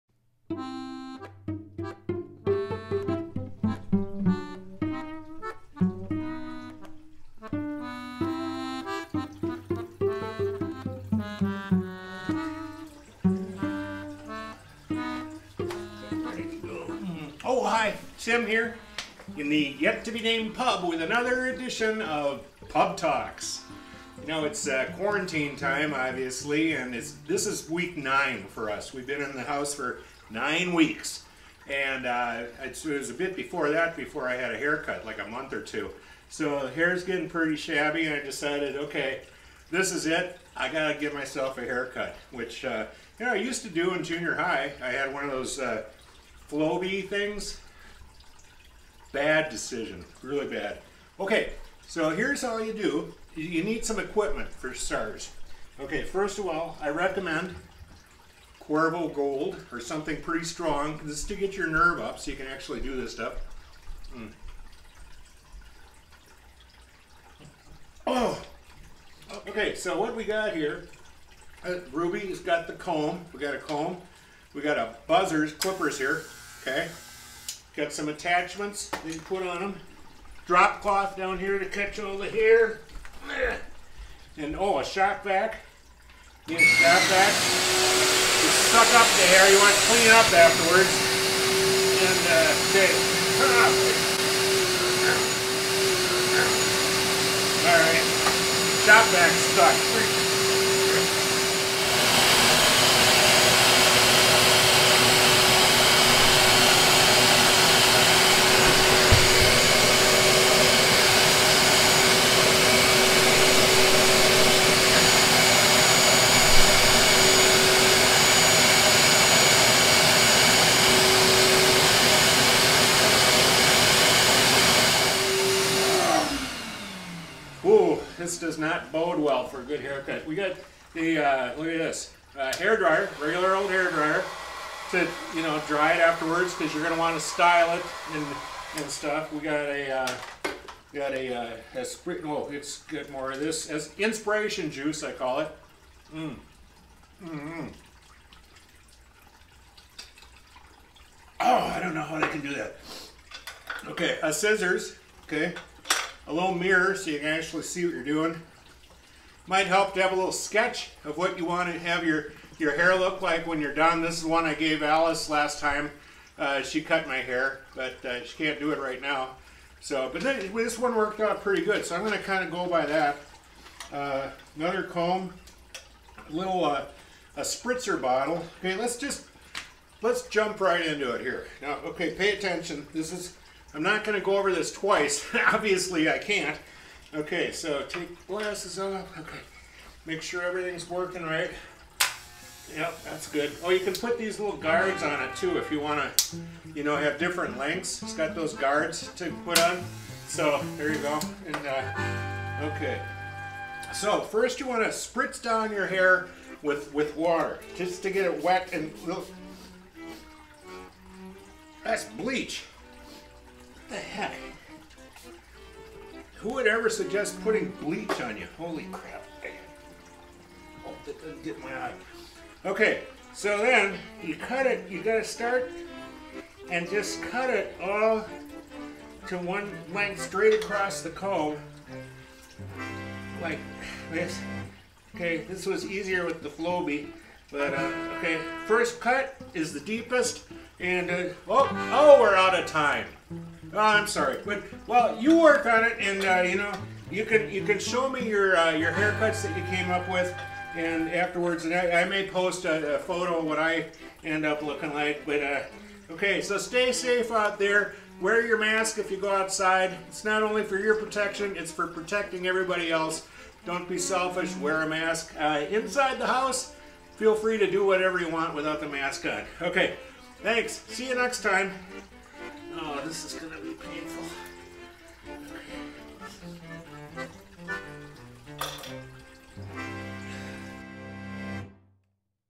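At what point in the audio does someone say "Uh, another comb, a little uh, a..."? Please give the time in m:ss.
2:53.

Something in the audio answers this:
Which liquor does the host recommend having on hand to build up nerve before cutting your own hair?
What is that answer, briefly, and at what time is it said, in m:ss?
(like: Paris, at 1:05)
Cuervo Gold, at 0:58.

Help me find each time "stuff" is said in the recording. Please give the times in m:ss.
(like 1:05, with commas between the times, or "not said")
1:03, 2:18.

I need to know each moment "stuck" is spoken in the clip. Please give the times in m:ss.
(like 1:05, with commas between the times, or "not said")
1:39.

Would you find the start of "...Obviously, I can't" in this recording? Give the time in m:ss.
3:05.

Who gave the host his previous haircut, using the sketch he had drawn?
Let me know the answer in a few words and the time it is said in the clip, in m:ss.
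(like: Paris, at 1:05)
Alice, at 2:44.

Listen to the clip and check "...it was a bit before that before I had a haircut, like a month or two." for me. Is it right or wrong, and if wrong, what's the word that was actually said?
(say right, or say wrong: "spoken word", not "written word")
right.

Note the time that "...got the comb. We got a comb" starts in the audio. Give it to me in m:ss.
1:12.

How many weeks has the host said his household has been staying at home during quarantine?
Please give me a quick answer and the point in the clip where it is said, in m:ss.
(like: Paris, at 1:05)
9, at 0:27.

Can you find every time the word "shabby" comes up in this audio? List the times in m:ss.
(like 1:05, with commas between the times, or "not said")
0:37.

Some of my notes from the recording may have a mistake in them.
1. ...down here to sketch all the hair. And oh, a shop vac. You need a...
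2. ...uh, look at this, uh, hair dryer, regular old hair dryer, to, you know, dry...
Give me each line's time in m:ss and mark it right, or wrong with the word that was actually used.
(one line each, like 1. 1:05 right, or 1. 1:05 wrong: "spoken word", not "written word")
1. 1:21 wrong: "catch", not "sketch"
2. 2:11 right.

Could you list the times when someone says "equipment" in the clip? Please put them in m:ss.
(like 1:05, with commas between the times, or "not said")
0:53.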